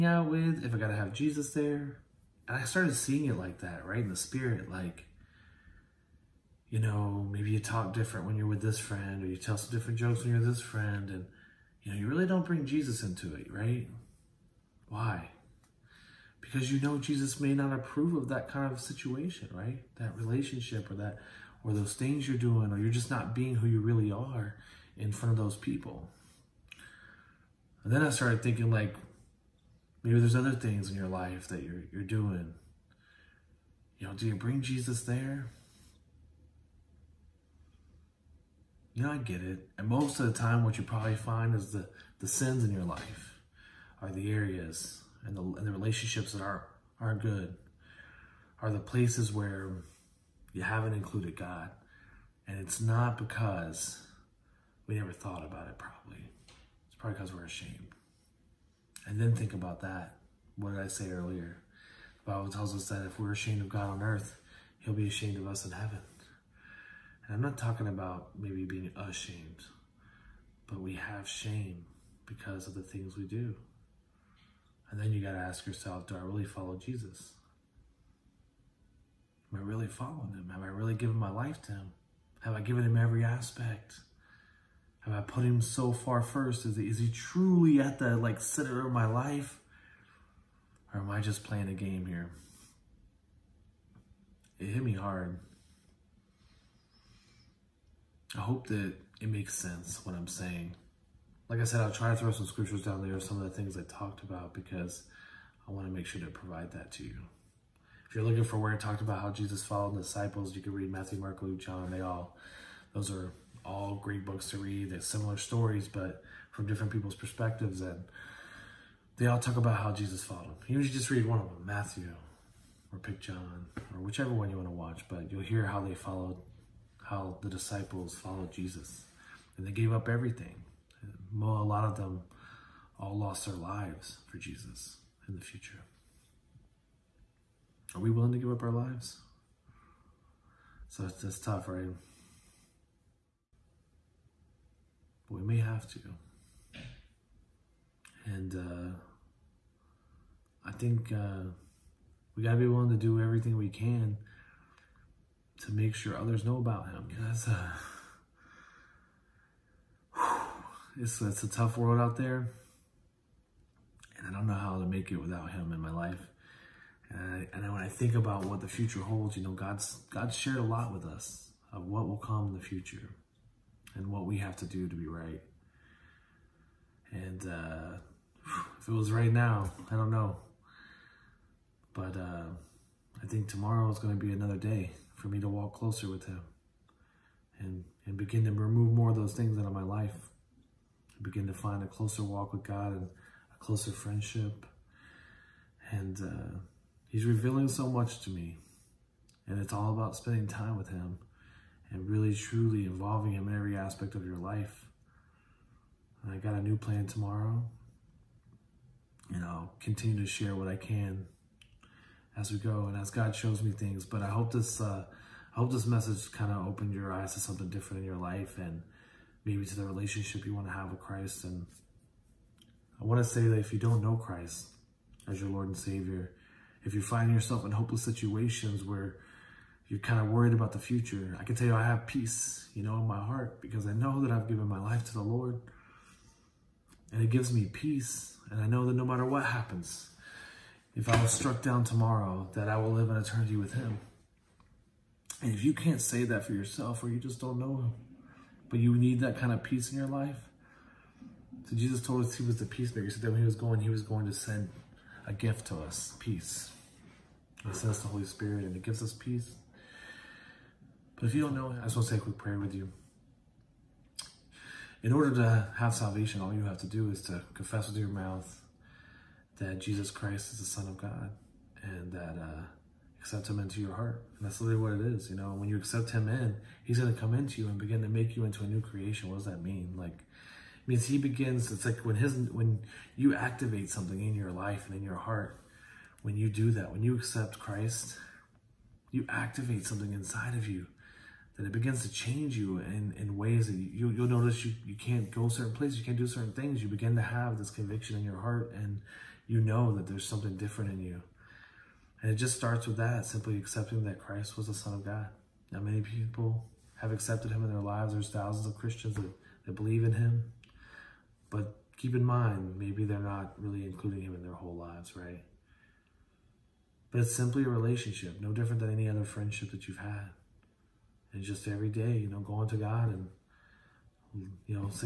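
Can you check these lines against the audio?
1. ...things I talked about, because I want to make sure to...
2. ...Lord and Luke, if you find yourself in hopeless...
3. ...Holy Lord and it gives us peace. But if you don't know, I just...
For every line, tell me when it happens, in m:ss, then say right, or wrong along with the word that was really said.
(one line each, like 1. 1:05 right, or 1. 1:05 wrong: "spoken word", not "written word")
1. 1:43 right
2. 3:45 wrong: "Savior", not "Luke"
3. 4:18 wrong: "Spirit", not "Lord".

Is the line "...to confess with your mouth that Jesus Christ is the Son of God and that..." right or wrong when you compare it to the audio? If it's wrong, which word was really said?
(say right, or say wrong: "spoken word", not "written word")
right.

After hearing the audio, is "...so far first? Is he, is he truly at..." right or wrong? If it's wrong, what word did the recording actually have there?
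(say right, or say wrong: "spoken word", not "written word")
right.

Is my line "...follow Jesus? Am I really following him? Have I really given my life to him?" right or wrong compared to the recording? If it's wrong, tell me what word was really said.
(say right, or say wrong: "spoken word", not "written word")
right.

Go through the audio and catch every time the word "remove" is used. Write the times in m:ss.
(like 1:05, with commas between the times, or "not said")
3:08.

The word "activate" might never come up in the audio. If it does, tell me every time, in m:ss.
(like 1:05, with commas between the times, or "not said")
4:43, 4:49.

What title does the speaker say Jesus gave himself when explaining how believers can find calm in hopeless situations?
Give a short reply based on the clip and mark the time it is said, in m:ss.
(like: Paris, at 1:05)
The peacemaker, at 4:12.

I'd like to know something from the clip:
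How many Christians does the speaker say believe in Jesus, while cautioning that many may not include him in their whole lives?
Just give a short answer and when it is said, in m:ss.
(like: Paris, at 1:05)
Thousands, at 5:08.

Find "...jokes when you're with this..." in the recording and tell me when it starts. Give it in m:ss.
0:09.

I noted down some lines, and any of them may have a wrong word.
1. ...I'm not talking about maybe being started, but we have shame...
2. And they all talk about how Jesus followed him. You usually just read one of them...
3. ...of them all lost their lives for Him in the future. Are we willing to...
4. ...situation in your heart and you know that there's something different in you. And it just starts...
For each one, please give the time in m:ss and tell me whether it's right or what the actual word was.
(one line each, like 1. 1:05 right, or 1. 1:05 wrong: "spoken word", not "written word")
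1. 1:07 wrong: "ashamed", not "started"
2. 1:57 right
3. 2:11 wrong: "Jesus", not "Him"
4. 4:57 wrong: "conviction", not "situation".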